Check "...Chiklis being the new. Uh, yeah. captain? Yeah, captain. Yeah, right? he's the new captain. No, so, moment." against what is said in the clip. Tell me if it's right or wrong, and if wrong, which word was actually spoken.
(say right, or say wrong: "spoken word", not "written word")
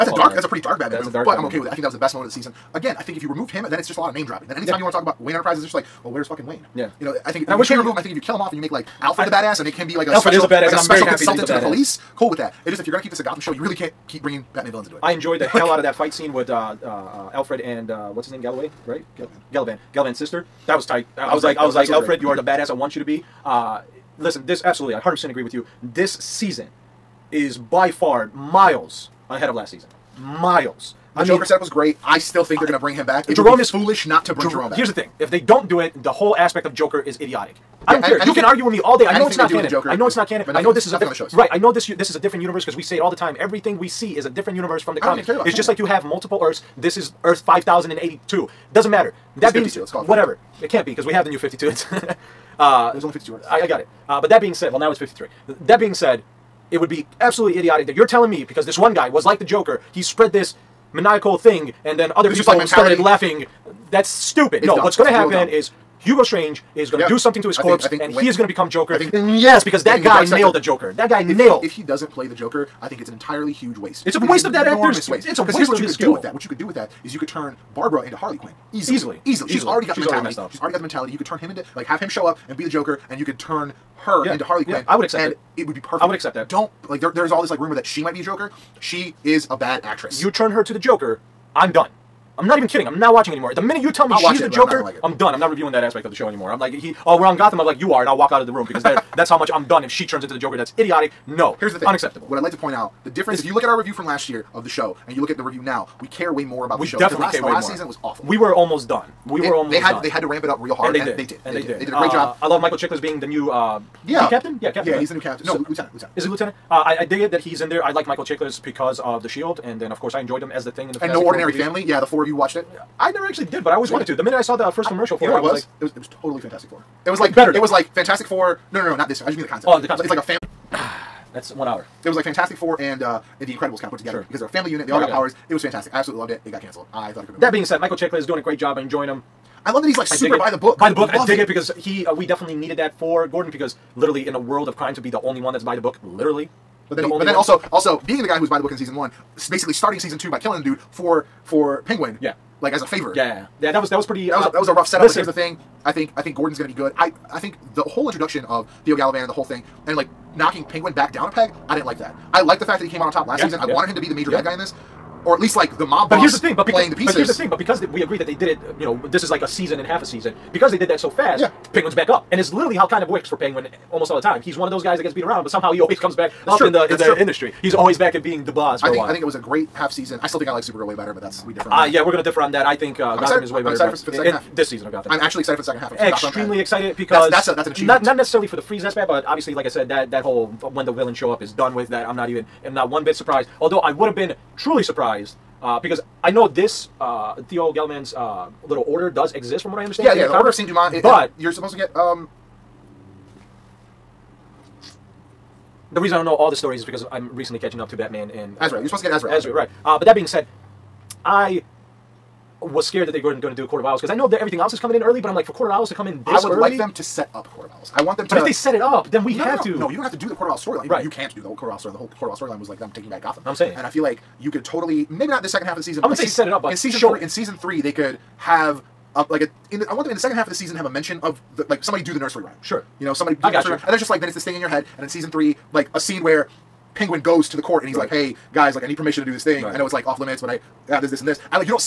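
wrong: "lieutenant", not "moment".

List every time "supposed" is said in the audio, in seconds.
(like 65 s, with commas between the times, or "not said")
201 s, 208 s.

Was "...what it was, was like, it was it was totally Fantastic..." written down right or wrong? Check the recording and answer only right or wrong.
right.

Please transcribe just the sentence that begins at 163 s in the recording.
wanted him to be the major yeah.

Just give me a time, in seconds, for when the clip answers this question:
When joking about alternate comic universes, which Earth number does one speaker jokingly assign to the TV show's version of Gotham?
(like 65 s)
47 s.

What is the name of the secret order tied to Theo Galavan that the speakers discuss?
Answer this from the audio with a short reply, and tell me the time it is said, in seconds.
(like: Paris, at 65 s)
Order of Saint Dumont, at 200 s.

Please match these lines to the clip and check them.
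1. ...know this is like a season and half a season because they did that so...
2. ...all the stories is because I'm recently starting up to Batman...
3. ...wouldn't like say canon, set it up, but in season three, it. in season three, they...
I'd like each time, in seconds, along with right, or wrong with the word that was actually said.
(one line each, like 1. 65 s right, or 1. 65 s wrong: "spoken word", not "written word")
1. 168 s right
2. 206 s wrong: "catching", not "starting"
3. 226 s wrong: "season", not "canon".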